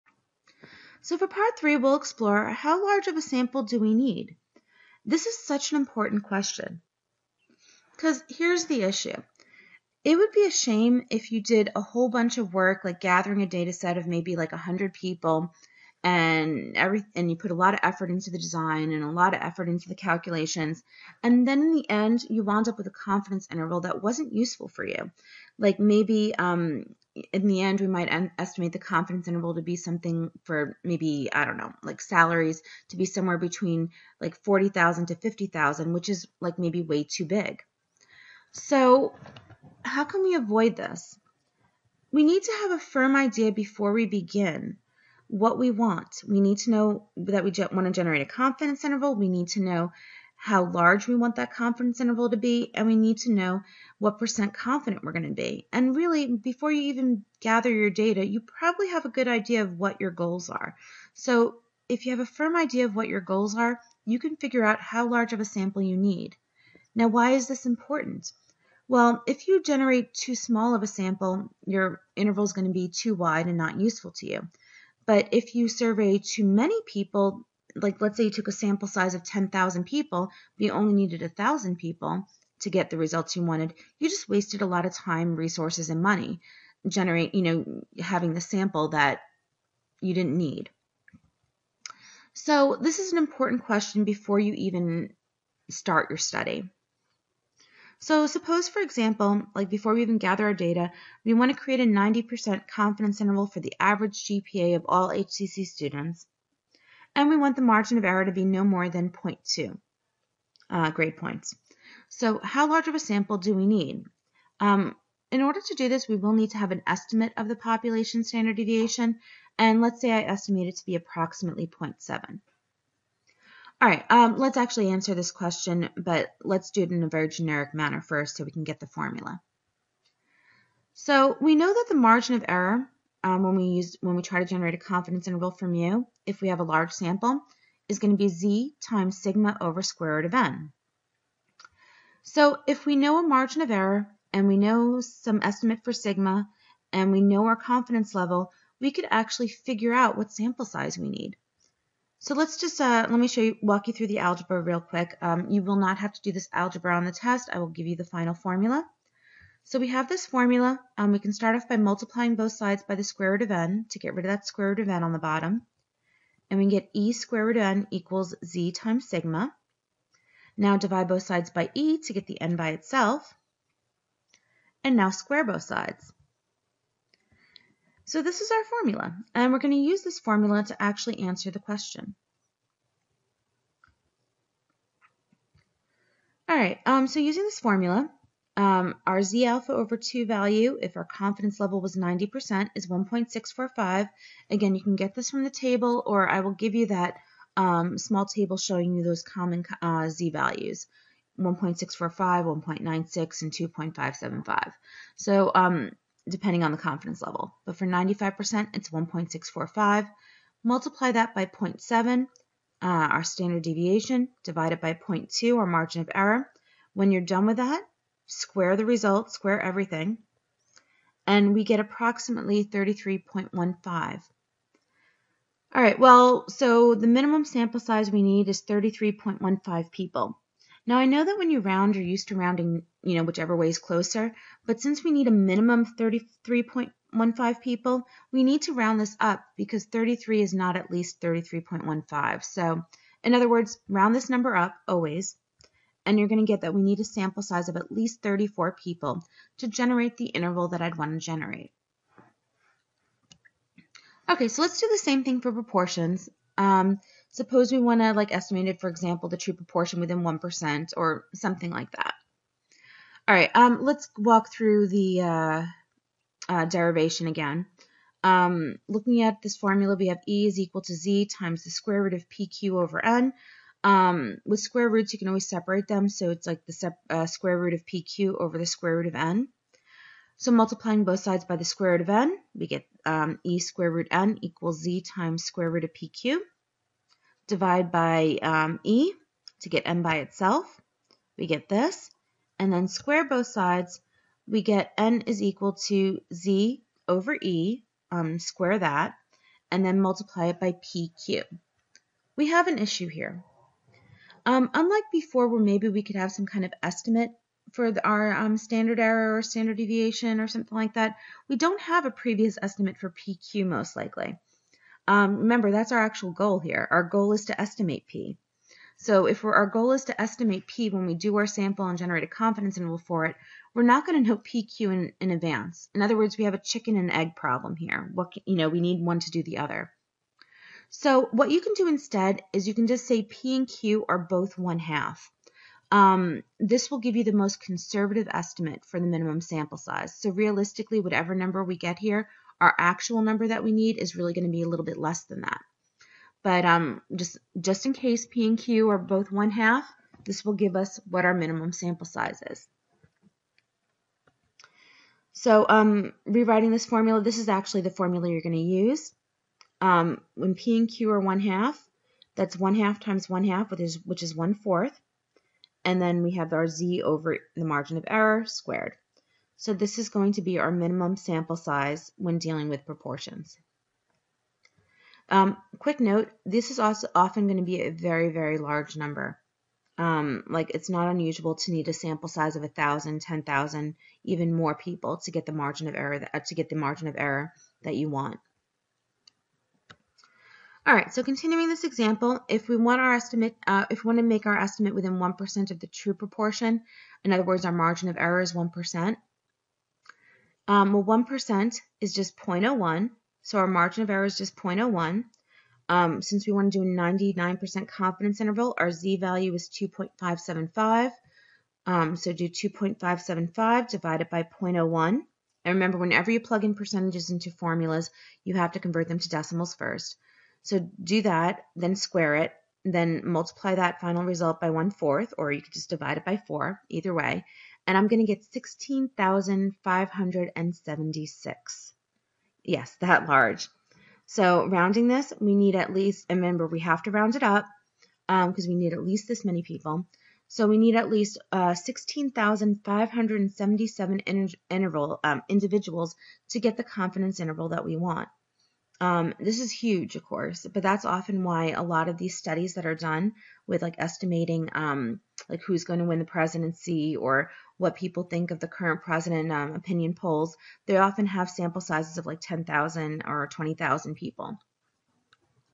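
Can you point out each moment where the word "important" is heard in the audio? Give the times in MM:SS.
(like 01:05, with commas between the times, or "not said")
00:05, 01:07, 01:33.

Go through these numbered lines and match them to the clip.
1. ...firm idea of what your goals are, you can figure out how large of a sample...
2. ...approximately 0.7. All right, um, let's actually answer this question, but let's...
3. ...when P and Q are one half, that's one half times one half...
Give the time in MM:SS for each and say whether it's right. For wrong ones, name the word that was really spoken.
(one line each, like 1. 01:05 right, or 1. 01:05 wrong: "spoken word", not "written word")
1. 01:02 right
2. 02:00 right
3. 06:00 right.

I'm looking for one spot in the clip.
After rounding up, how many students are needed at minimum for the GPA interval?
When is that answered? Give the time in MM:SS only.
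04:08.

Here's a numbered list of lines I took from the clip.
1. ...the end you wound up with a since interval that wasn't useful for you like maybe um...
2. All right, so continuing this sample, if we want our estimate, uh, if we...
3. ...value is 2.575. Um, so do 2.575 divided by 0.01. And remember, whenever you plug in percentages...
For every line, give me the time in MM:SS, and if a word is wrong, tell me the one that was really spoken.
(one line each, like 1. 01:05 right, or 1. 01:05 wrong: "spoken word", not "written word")
1. 00:21 wrong: "confidence", not "since"
2. 06:30 wrong: "example", not "sample"
3. 06:49 right.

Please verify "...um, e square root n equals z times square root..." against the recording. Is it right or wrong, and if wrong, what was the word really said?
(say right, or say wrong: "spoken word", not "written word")
right.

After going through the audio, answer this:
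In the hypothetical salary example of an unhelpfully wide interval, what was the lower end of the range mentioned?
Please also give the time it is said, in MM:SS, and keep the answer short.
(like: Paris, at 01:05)
40,000, at 00:34.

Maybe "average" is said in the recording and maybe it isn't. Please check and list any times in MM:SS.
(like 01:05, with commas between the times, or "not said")
01:43.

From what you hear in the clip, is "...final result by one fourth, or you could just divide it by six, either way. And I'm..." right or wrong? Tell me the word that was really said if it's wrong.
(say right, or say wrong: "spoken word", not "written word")
wrong: "four", not "six".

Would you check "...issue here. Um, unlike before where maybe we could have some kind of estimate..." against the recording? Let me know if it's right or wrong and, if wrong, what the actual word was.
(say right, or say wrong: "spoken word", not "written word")
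right.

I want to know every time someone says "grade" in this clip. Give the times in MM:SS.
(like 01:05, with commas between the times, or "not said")
01:50.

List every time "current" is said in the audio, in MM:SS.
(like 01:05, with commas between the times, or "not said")
07:38.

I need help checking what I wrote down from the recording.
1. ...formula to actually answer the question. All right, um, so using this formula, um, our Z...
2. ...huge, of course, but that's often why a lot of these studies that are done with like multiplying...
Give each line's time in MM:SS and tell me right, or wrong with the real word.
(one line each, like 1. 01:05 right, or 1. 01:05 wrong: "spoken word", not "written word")
1. 03:00 right
2. 07:29 wrong: "estimating", not "multiplying".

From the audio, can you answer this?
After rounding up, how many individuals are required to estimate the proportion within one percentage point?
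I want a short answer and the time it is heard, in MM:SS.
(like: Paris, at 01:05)
16,577, at 07:21.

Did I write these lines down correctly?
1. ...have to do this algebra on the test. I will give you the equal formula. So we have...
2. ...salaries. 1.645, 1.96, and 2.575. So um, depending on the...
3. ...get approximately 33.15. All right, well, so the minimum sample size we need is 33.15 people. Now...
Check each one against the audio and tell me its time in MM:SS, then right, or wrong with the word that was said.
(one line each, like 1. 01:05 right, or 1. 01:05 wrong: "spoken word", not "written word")
1. 02:35 wrong: "final", not "equal"
2. 03:20 wrong: "values", not "salaries"
3. 03:41 right.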